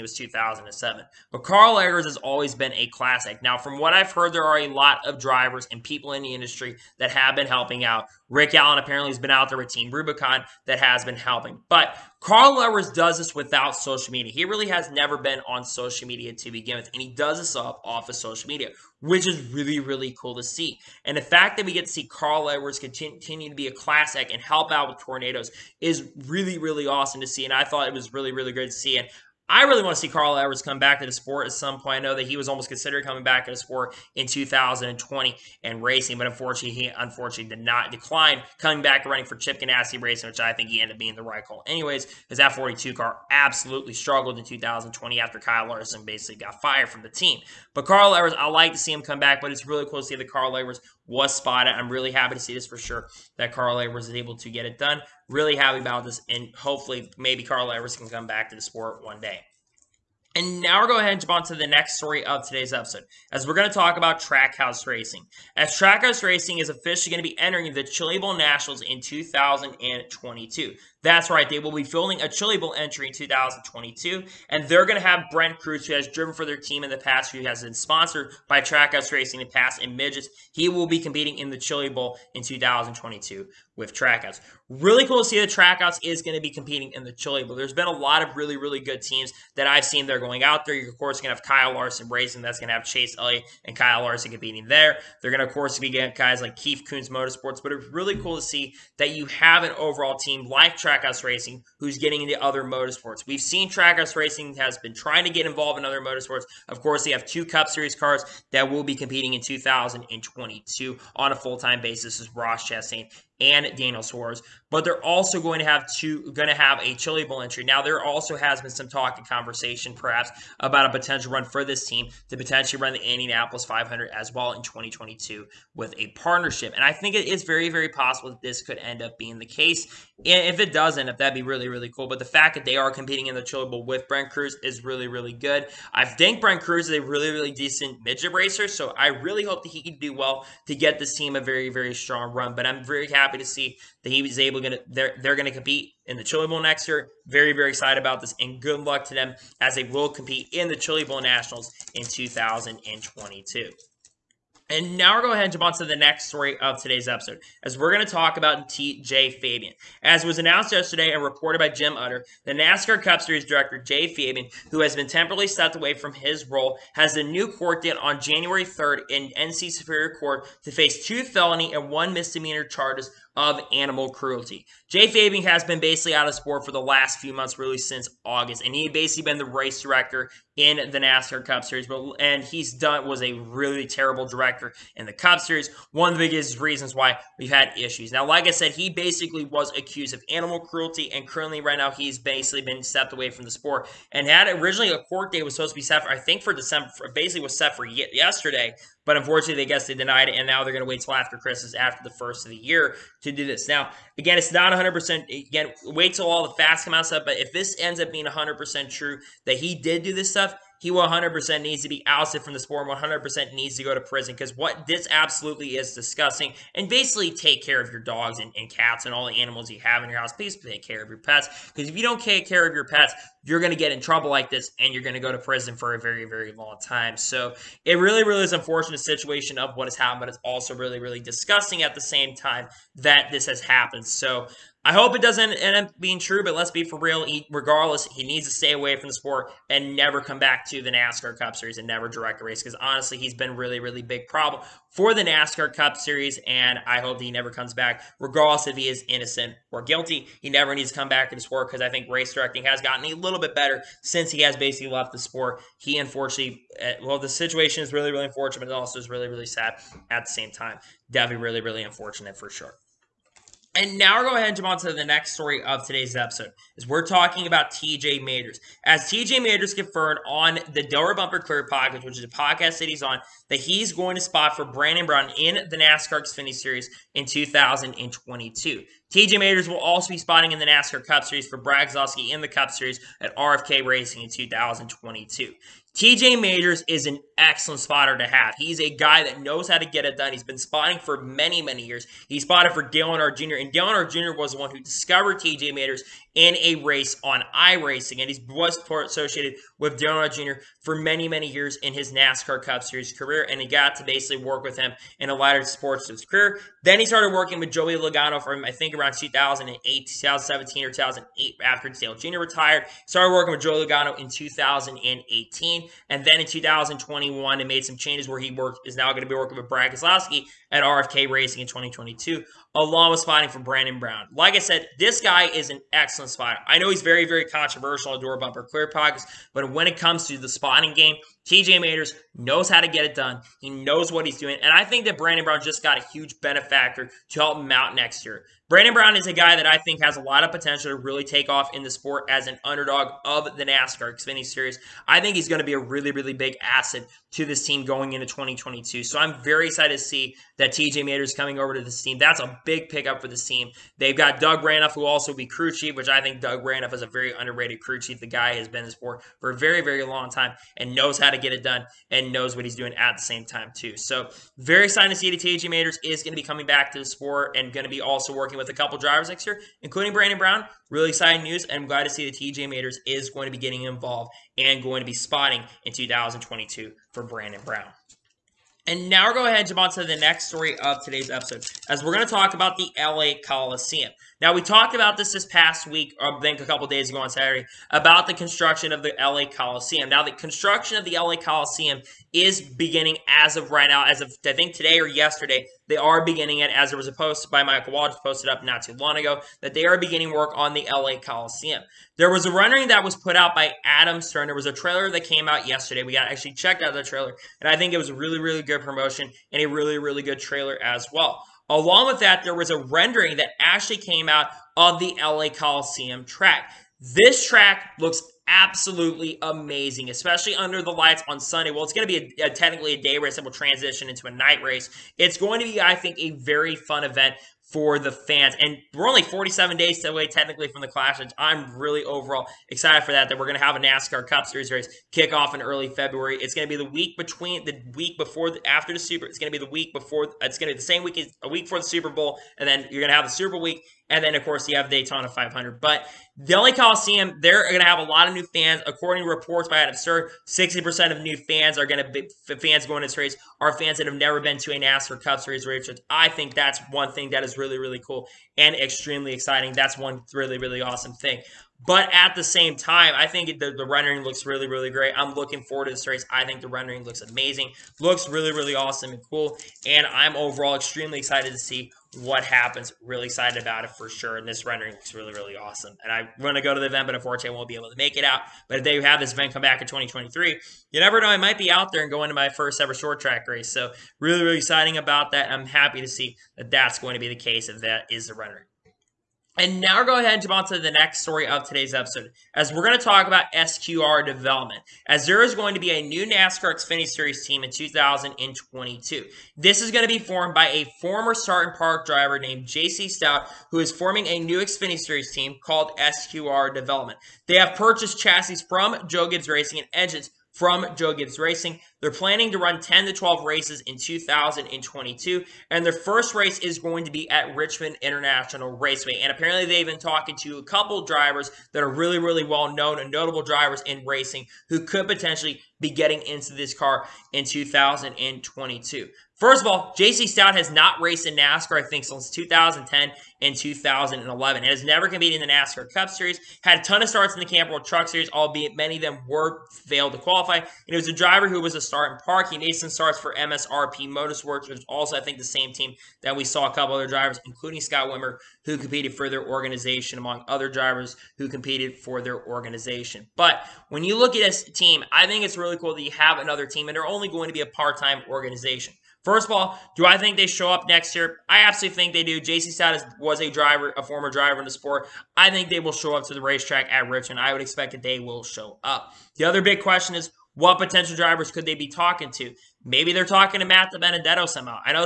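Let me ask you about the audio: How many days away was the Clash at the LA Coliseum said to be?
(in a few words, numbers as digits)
47.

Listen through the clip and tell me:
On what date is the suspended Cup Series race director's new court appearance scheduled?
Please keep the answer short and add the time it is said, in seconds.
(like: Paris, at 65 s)
January 3rd, at 168 s.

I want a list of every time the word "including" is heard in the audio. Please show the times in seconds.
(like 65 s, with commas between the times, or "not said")
369 s, 547 s.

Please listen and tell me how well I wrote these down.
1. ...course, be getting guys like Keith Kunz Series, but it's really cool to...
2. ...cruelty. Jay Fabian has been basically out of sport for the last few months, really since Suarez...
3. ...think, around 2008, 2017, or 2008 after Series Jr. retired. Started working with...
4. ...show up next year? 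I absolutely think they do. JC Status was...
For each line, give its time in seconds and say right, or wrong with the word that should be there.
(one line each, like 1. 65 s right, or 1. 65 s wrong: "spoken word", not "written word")
1. 95 s wrong: "Motorsports", not "Series"
2. 174 s wrong: "August", not "Suarez"
3. 308 s wrong: "Dale", not "Series"
4. 560 s right.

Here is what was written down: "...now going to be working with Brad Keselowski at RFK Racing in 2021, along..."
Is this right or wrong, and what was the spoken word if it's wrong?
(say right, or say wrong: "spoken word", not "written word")
wrong: "2022", not "2021".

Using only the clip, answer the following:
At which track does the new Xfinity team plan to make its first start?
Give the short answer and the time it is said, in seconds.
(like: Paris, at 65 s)
Richmond International Raceway, at 517 s.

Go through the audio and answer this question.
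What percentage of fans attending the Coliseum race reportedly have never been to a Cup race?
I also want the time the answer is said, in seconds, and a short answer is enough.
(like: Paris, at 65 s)
60%, at 449 s.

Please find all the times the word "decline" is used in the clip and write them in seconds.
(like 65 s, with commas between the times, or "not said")
37 s.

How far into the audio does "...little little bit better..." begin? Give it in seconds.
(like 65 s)
253 s.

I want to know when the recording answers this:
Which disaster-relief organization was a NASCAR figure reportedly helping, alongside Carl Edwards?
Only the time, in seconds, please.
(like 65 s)
9 s.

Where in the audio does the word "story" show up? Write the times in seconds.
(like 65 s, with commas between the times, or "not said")
61 s, 156 s, 265 s, 380 s, 491 s.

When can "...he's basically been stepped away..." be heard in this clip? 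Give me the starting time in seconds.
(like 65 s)
191 s.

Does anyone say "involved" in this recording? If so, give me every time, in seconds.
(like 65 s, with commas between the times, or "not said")
105 s, 373 s.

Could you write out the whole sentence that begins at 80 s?
He will be competing in the Chili Bowl in 2022 with Trackhouse.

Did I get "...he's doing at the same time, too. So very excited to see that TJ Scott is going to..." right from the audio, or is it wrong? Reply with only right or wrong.
wrong.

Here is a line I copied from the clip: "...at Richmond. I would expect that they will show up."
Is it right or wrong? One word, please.
right.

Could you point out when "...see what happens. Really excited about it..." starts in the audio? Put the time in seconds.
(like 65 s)
471 s.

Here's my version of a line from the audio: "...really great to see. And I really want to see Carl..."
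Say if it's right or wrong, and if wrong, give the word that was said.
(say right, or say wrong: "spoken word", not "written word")
right.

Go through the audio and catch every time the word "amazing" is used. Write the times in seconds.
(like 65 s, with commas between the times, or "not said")
419 s, 467 s.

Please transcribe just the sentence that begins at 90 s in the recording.
You're, of course, going to have Kyle Larson racing.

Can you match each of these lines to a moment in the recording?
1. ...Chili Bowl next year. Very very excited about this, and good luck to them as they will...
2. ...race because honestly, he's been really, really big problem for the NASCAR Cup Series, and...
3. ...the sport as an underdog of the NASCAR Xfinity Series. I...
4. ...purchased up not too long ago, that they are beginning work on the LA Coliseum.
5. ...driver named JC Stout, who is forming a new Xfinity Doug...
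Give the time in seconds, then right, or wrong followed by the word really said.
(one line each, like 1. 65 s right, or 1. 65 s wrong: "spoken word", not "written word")
1. 146 s right
2. 242 s right
3. 341 s right
4. 398 s wrong: "posted", not "purchased"
5. 502 s wrong: "Series", not "Doug".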